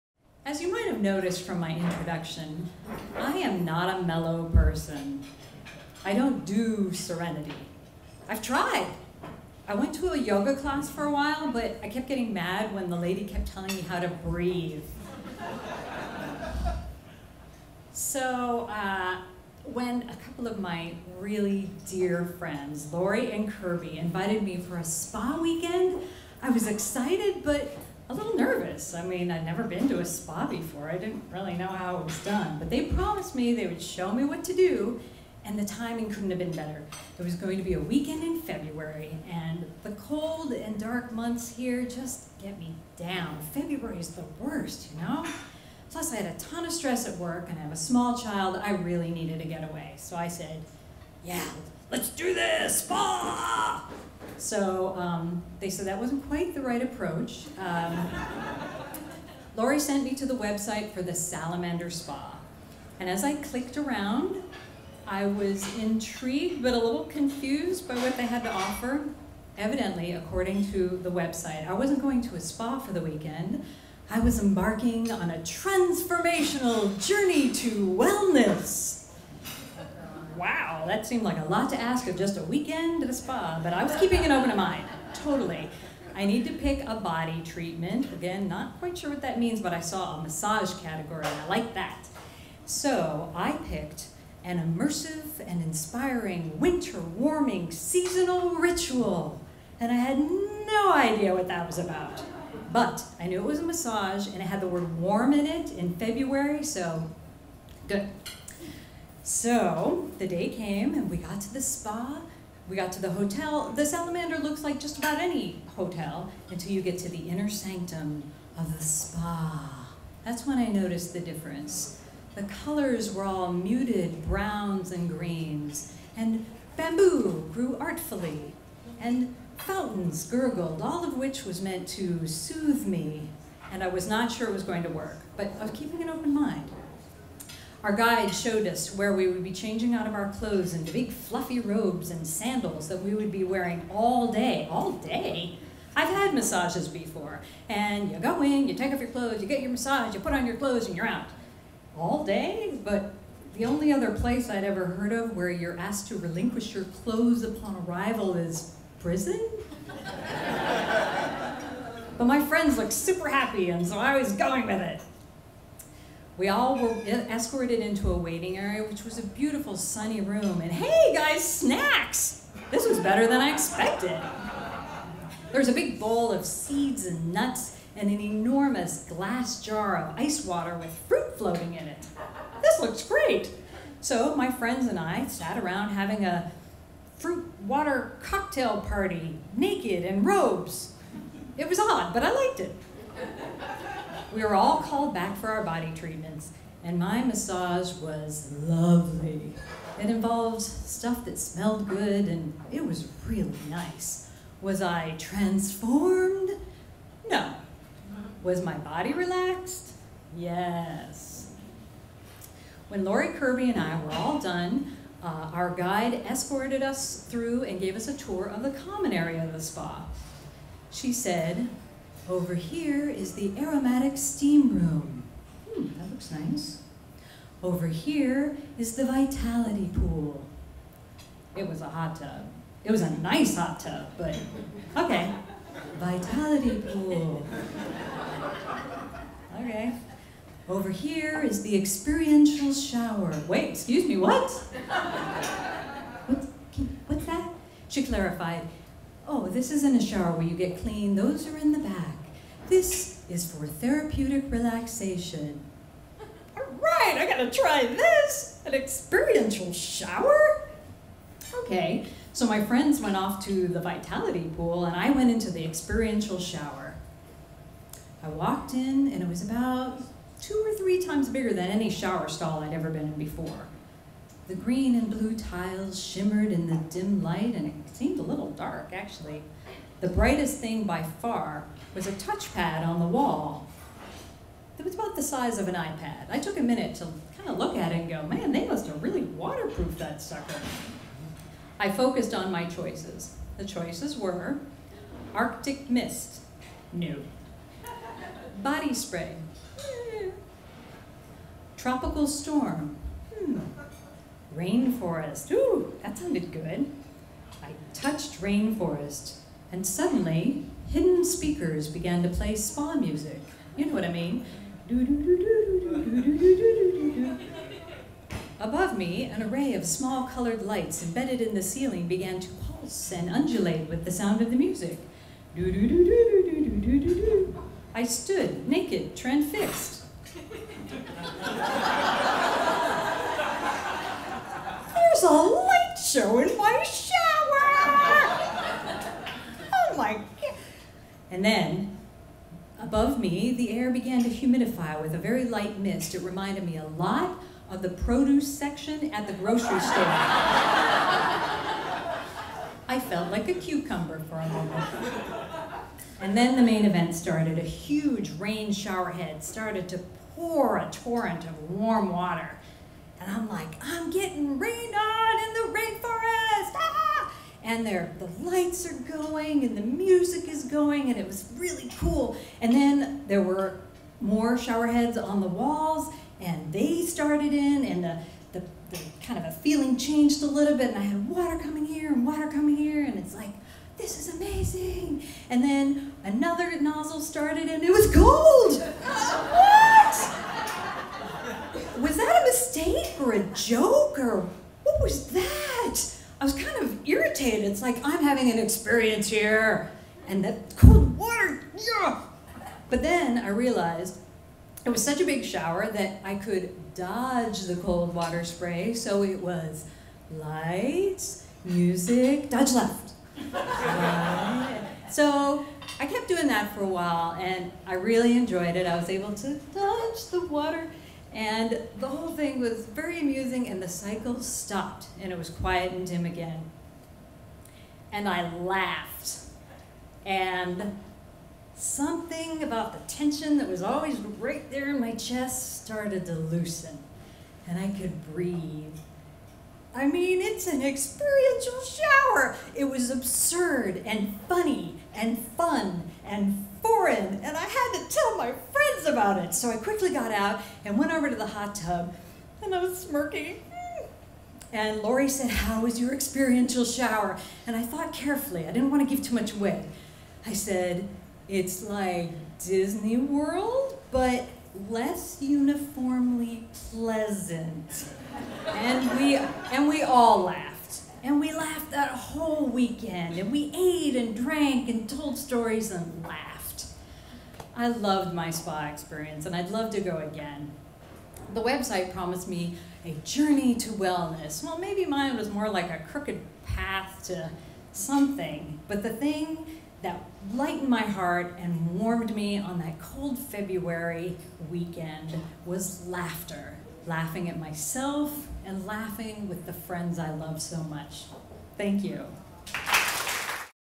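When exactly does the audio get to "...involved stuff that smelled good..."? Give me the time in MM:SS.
03:20.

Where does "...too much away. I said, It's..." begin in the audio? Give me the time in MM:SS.
07:39.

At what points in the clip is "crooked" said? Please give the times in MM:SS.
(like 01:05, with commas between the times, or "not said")
08:06.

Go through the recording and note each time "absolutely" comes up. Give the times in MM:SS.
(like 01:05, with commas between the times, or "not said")
not said.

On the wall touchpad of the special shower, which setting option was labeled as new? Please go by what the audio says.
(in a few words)
Arctic Mist.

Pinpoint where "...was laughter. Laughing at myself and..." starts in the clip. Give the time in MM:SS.
08:15.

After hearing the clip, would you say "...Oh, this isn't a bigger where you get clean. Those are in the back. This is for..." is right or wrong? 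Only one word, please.
wrong.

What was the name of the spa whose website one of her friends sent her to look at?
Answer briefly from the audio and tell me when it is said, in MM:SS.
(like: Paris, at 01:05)
Salamander Spa, at 01:01.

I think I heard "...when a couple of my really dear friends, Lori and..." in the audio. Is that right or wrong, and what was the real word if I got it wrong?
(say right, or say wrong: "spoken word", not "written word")
right.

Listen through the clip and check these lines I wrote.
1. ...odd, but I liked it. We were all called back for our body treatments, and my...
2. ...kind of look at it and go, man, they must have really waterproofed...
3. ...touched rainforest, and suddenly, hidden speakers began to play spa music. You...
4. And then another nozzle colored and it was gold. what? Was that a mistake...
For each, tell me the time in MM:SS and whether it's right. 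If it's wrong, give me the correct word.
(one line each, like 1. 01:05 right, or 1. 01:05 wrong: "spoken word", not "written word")
1. 03:11 right
2. 04:47 right
3. 05:07 right
4. 06:25 wrong: "started", not "colored".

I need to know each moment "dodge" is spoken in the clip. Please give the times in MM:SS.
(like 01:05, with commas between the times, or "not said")
06:46, 06:52, 06:59.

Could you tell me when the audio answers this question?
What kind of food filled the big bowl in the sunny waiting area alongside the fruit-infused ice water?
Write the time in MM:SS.
02:56.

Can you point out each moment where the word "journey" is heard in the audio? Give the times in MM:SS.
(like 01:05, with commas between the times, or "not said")
01:17, 08:03.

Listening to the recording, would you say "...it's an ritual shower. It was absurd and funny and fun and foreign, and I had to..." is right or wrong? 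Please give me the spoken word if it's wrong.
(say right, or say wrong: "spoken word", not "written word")
wrong: "experiential", not "ritual".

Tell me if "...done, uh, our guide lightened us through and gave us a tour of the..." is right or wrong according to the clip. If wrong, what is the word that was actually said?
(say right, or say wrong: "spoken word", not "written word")
wrong: "escorted", not "lightened".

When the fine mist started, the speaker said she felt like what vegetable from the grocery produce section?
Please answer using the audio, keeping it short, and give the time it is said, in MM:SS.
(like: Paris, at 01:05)
Cucumber, at 05:53.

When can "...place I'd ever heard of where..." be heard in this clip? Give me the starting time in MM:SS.
02:34.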